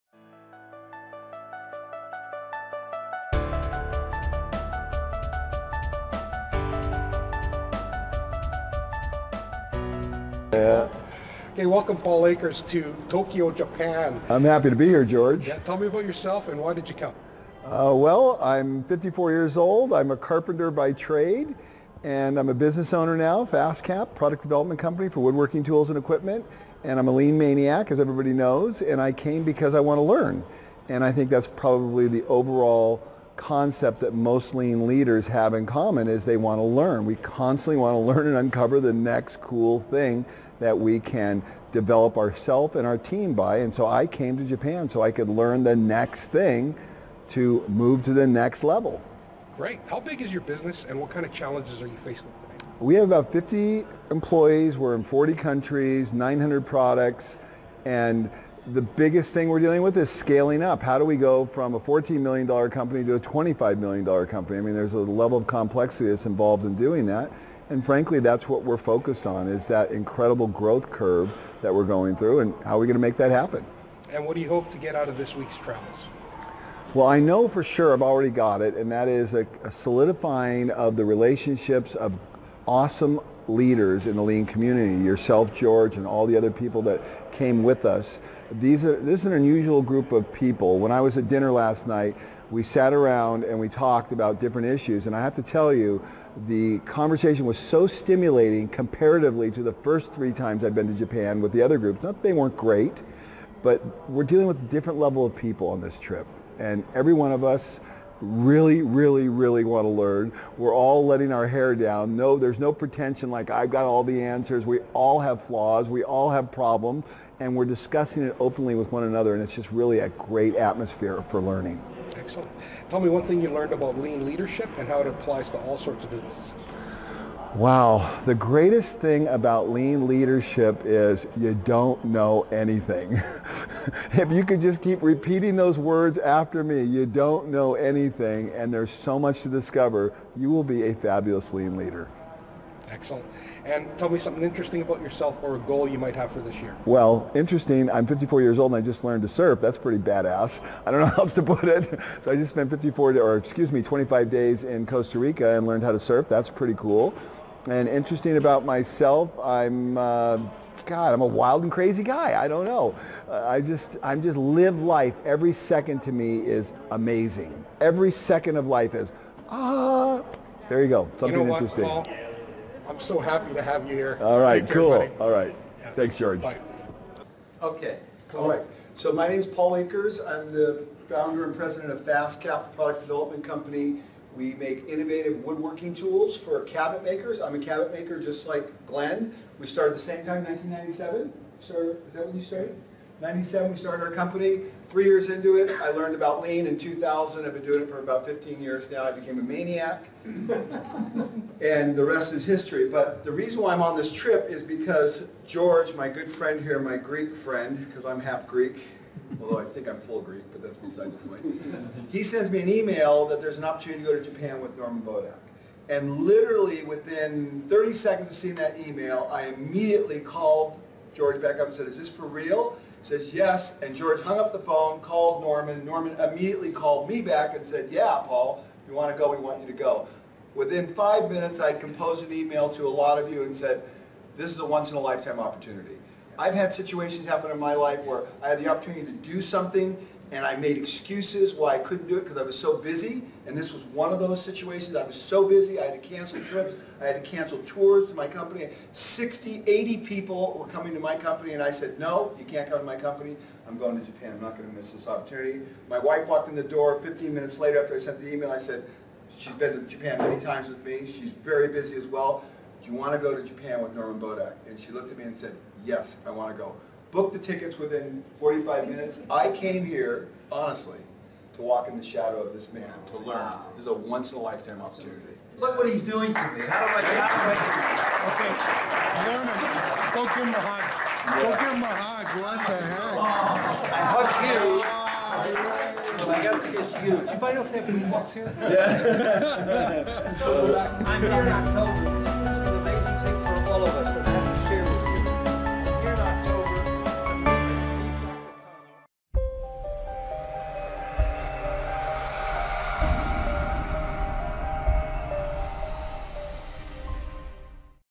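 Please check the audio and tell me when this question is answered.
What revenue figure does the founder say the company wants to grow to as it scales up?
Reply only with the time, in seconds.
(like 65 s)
63 s.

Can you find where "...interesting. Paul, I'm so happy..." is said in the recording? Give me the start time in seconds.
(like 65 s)
171 s.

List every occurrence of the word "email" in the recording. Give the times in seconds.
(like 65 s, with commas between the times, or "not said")
212 s, 218 s, 232 s, 258 s.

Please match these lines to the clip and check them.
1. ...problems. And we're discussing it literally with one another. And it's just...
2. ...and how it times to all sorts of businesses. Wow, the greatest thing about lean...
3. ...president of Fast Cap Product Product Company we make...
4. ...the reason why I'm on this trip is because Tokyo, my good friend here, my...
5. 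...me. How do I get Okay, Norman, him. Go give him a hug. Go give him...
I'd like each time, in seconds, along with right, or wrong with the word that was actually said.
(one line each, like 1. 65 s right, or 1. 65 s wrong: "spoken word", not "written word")
1. 116 s wrong: "openly", not "literally"
2. 124 s wrong: "applies", not "times"
3. 181 s wrong: "Development", not "Product"
4. 203 s wrong: "George", not "Tokyo"
5. 276 s right.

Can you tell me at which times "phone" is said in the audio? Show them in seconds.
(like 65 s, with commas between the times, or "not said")
224 s.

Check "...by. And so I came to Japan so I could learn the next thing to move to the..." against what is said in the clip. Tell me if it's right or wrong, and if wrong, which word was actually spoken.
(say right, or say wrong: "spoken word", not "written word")
right.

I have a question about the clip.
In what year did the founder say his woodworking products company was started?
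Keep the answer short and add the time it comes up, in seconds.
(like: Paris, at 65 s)
1997, at 190 s.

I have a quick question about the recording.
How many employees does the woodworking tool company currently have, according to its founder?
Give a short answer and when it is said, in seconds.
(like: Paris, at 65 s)
50, at 53 s.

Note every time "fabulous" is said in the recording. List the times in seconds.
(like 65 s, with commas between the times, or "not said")
140 s.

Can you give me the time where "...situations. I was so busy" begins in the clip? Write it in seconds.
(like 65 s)
244 s.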